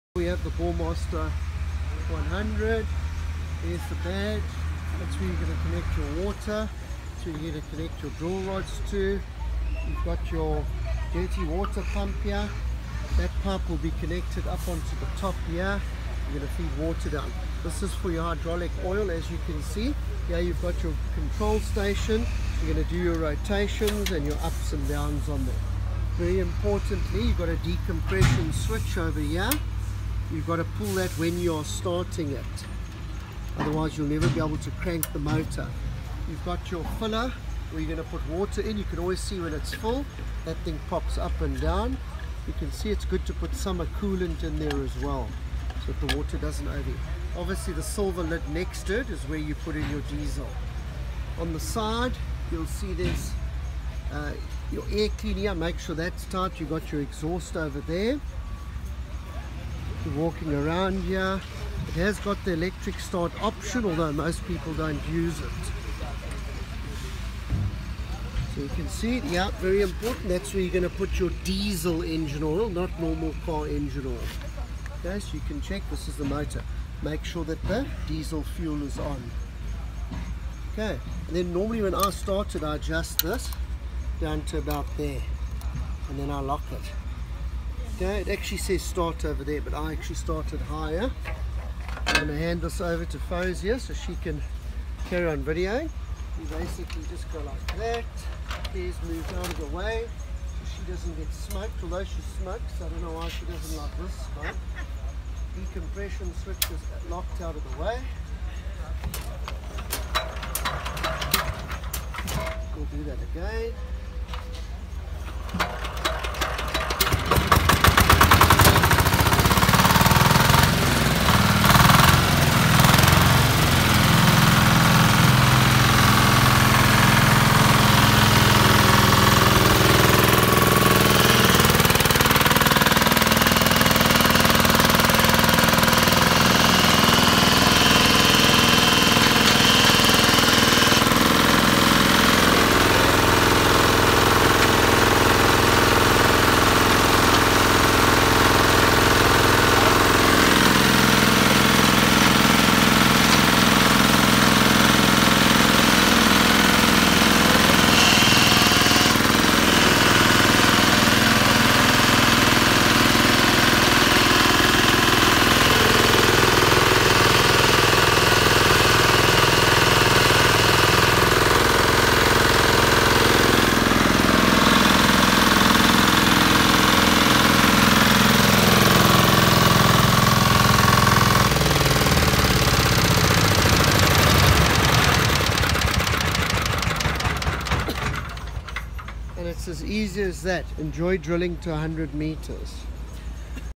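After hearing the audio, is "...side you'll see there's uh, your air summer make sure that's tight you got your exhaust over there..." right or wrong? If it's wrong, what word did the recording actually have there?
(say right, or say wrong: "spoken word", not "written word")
wrong: "cleaner", not "summer".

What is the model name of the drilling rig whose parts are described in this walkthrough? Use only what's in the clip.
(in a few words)
Bowmaster 100.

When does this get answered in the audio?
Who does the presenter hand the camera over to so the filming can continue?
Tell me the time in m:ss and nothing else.
1:33.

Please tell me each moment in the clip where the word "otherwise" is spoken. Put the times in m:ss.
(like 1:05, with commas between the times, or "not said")
0:33.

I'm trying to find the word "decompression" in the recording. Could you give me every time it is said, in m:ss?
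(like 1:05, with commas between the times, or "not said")
0:27, 1:45.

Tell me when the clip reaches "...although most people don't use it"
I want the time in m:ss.
1:03.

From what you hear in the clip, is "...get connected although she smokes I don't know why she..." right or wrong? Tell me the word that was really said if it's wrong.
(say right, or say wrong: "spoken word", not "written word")
wrong: "smoked", not "connected".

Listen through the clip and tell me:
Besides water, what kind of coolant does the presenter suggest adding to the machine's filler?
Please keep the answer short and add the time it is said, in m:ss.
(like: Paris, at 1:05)
Summer coolant, at 0:43.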